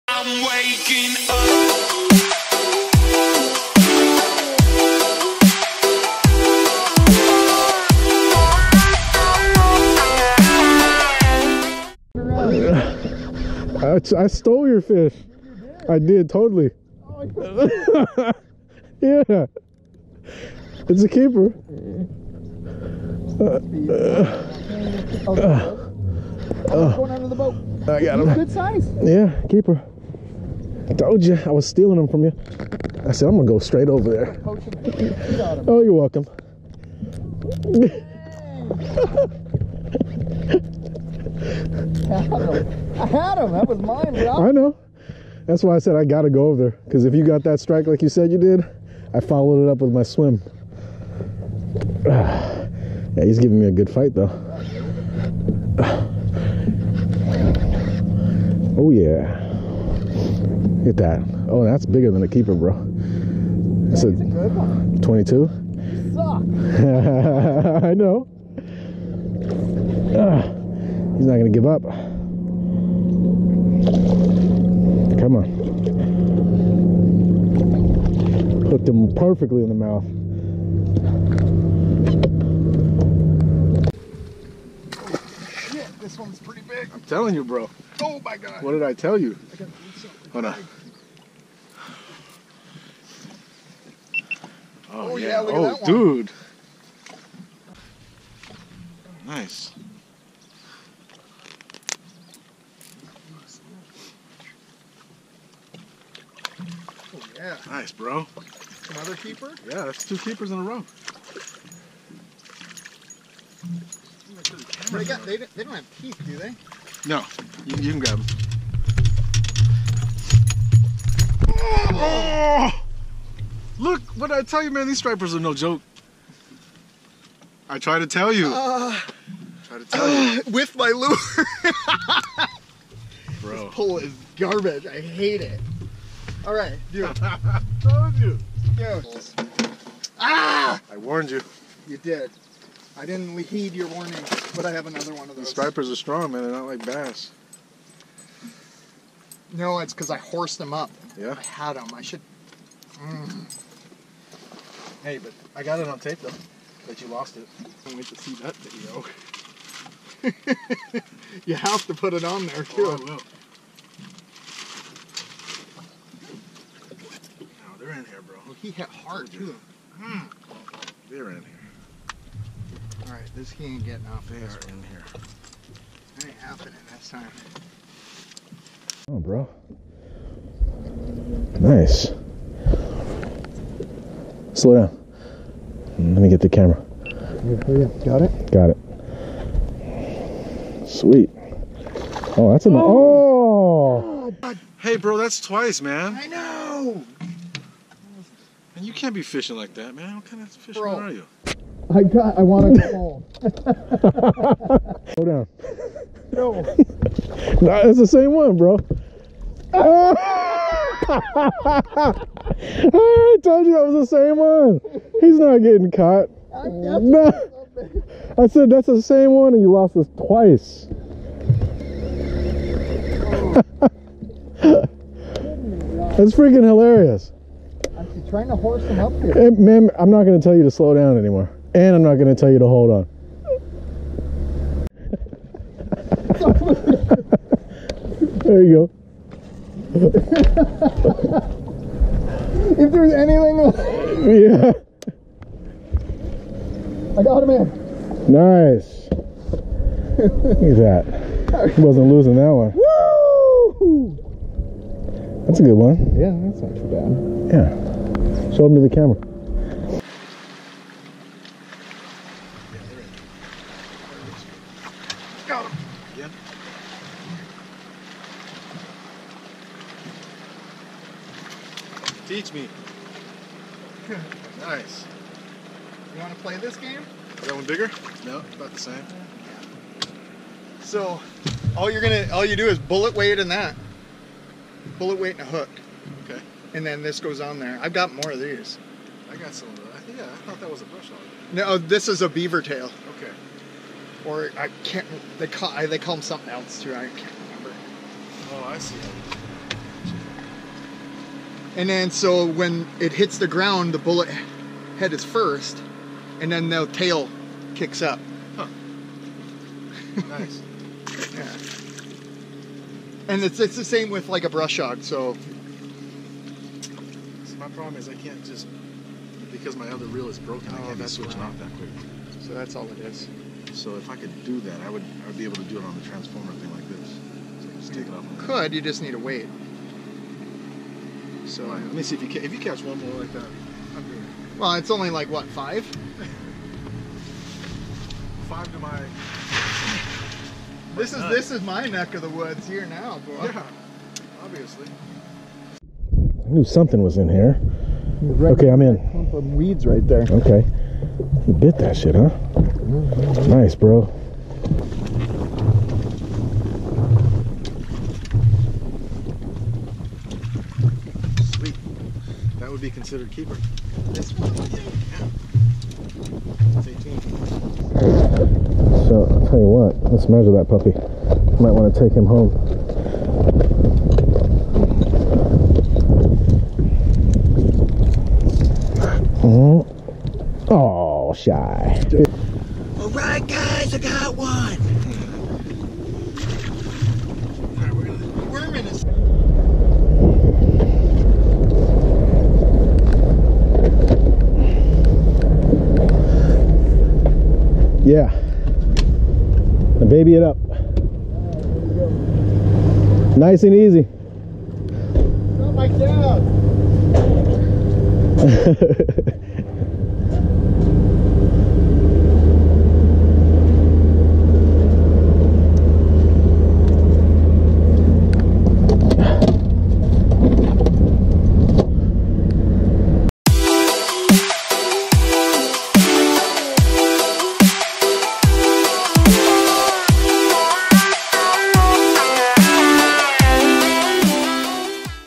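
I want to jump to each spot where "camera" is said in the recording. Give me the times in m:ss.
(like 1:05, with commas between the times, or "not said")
3:06, 4:18.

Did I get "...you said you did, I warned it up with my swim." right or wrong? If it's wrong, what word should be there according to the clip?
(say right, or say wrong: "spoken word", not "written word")
wrong: "followed", not "warned".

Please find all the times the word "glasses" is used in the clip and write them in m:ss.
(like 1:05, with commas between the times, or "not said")
not said.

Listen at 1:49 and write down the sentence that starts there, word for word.
Yeah, that's two keepers in a row.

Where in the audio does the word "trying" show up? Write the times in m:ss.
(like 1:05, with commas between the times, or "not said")
3:48.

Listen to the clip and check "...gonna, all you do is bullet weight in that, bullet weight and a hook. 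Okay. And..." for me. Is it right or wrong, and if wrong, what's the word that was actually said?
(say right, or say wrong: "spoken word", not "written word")
right.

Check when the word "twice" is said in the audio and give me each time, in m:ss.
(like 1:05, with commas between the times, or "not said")
3:15, 3:40.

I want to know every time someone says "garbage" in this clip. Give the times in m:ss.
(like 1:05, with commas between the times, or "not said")
2:14.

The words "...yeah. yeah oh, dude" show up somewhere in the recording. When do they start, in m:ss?
1:35.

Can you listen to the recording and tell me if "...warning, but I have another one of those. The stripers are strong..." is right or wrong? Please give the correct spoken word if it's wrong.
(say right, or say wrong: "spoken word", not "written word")
right.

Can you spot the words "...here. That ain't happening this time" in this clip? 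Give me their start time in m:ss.
2:54.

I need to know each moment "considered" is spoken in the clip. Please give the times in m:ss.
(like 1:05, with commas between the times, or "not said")
6:02.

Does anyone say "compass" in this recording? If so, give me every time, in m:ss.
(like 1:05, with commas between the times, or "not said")
not said.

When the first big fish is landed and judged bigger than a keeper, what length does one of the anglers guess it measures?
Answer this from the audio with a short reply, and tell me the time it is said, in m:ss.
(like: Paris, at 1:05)
22, at 1:05.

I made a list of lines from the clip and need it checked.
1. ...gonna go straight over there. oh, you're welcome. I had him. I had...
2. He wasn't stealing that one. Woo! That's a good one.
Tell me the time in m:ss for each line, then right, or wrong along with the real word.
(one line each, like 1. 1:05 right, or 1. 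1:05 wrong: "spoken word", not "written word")
1. 0:33 right
2. 4:11 wrong: "losing", not "stealing".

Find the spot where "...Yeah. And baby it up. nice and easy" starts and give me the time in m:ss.
6:38.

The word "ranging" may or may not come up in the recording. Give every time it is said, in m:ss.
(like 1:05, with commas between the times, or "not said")
not said.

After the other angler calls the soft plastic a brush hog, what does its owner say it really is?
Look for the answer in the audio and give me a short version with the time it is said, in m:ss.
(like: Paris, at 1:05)
Beaver tail, at 4:51.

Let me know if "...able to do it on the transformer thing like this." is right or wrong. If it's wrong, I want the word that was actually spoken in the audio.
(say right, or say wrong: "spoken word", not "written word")
right.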